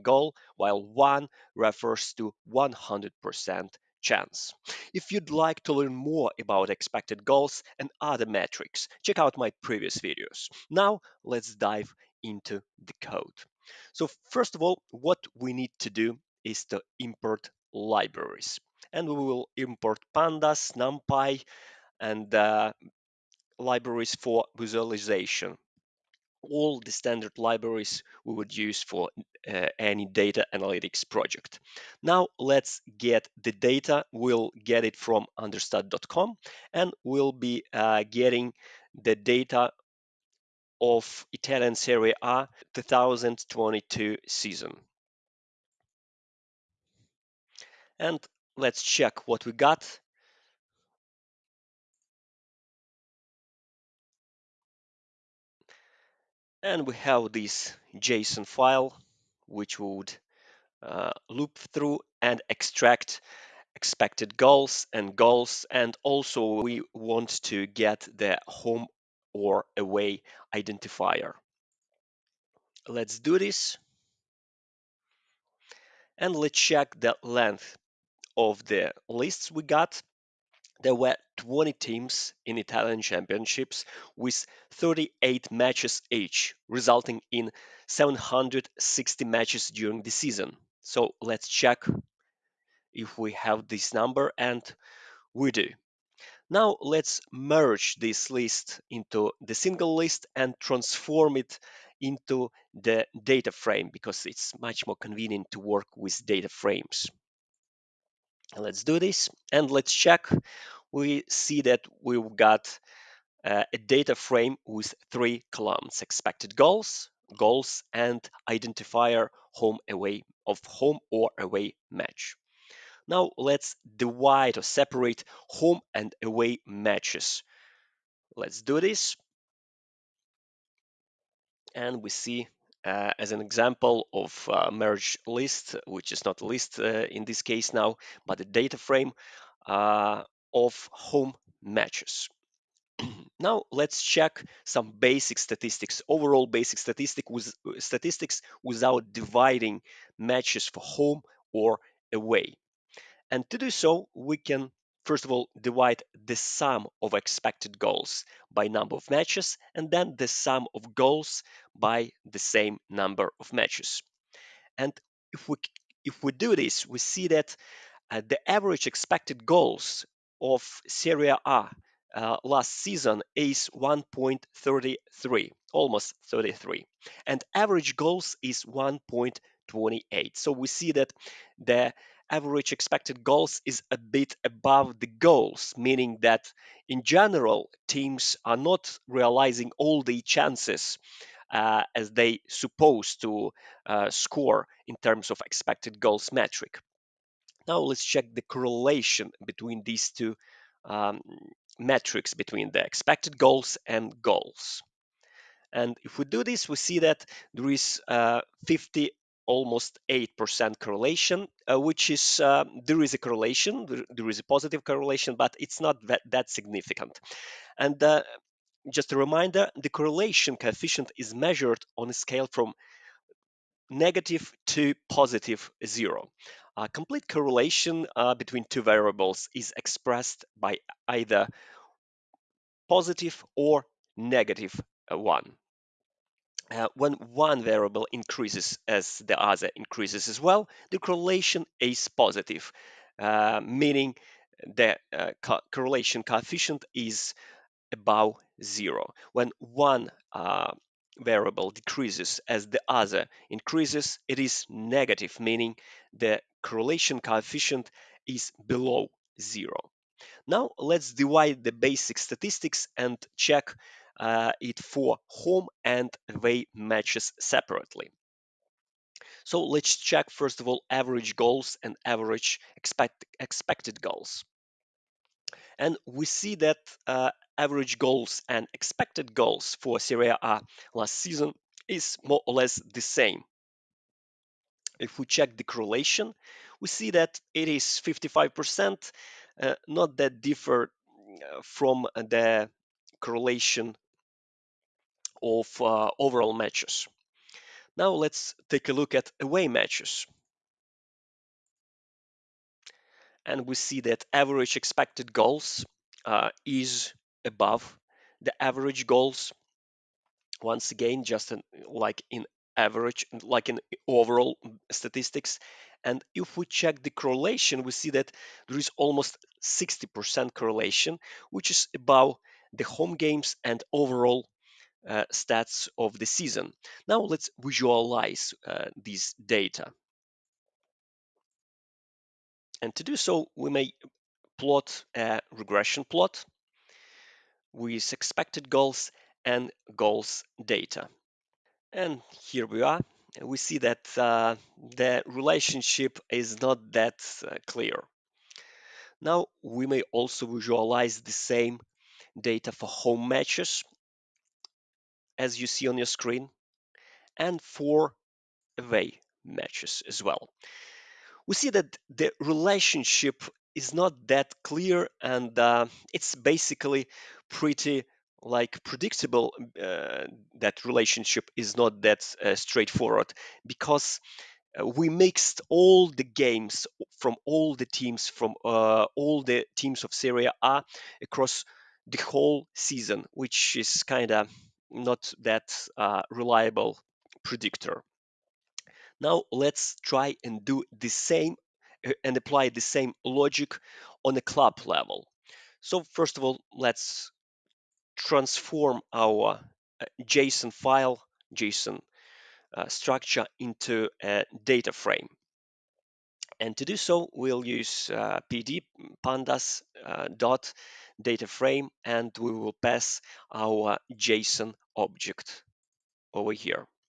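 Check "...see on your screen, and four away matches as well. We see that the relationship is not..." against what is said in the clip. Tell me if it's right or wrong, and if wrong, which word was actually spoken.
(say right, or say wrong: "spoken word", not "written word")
right.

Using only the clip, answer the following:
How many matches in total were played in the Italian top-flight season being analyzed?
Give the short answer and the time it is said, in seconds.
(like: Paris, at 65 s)
760, at 87 s.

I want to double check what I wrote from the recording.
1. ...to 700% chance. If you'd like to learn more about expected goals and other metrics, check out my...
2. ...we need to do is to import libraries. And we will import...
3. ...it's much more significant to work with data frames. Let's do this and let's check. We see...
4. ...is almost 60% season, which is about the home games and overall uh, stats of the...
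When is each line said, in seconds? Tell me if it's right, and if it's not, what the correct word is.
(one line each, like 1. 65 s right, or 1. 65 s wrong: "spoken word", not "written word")
1. 2 s wrong: "100", not "700"
2. 15 s right
3. 104 s wrong: "convenient", not "significant"
4. 318 s wrong: "correlation", not "season".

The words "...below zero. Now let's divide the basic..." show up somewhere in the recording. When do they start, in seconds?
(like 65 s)
258 s.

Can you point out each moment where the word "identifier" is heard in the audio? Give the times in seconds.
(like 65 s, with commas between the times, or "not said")
70 s, 118 s.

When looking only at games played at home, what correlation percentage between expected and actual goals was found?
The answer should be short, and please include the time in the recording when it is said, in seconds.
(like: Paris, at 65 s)
55%, at 288 s.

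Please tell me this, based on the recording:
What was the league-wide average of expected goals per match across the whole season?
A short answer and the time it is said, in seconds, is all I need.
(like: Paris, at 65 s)
1.33, at 173 s.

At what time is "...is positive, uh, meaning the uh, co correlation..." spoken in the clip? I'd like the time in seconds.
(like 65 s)
241 s.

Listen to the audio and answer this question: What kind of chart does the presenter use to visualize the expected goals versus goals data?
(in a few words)
regression plot.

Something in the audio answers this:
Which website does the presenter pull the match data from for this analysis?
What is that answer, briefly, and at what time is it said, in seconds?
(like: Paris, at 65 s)
understat.com, at 35 s.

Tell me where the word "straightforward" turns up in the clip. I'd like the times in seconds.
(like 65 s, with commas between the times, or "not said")
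372 s.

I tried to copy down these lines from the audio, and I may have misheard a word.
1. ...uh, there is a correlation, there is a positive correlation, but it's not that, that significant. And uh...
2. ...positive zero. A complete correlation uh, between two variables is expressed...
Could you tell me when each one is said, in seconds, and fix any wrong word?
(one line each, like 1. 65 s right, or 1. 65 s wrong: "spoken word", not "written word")
1. 212 s right
2. 225 s right.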